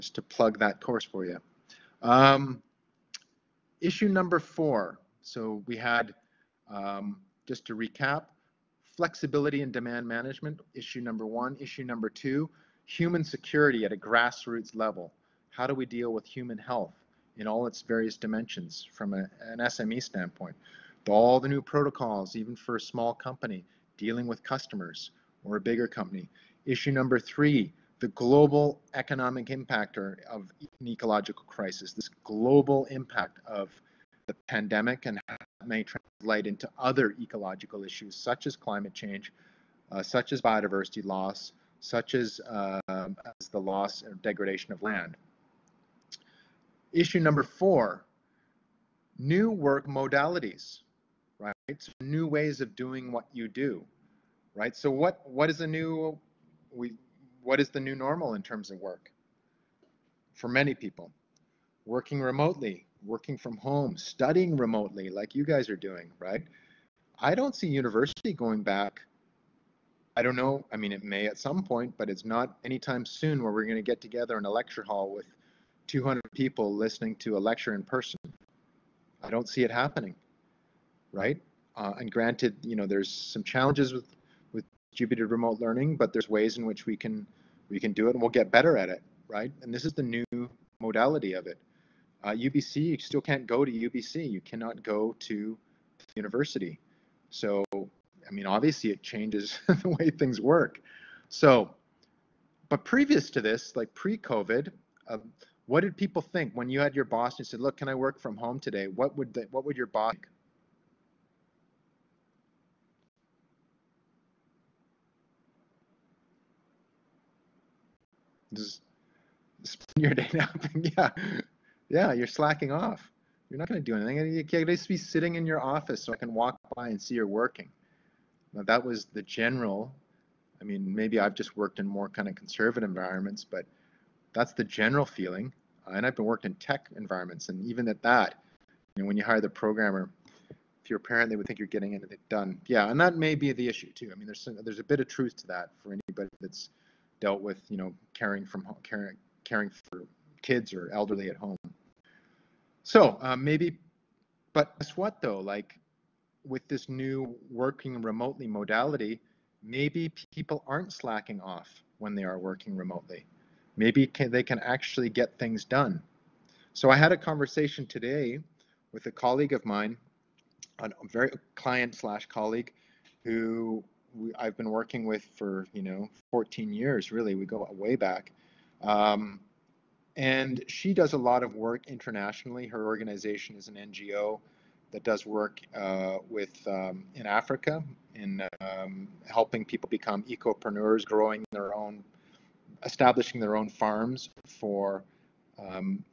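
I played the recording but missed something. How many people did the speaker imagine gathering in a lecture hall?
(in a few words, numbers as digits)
200.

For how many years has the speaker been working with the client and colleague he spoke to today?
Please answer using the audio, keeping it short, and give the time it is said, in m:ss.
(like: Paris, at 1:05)
14, at 2:56.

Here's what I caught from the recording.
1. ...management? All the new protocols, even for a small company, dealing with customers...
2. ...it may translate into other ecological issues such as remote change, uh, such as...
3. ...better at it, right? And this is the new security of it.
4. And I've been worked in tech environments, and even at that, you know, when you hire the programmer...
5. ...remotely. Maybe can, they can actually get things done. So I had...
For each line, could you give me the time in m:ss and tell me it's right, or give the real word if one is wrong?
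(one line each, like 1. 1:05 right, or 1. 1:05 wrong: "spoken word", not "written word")
1. 0:20 wrong: "standpoint", not "management"
2. 0:35 wrong: "climate", not "remote"
3. 1:28 wrong: "modality", not "security"
4. 2:15 right
5. 2:42 right.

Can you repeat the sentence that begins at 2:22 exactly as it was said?
Yeah, and that may be the issue too.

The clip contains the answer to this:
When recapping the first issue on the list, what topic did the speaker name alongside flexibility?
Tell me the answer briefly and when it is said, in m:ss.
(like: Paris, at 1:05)
demand management, at 0:09.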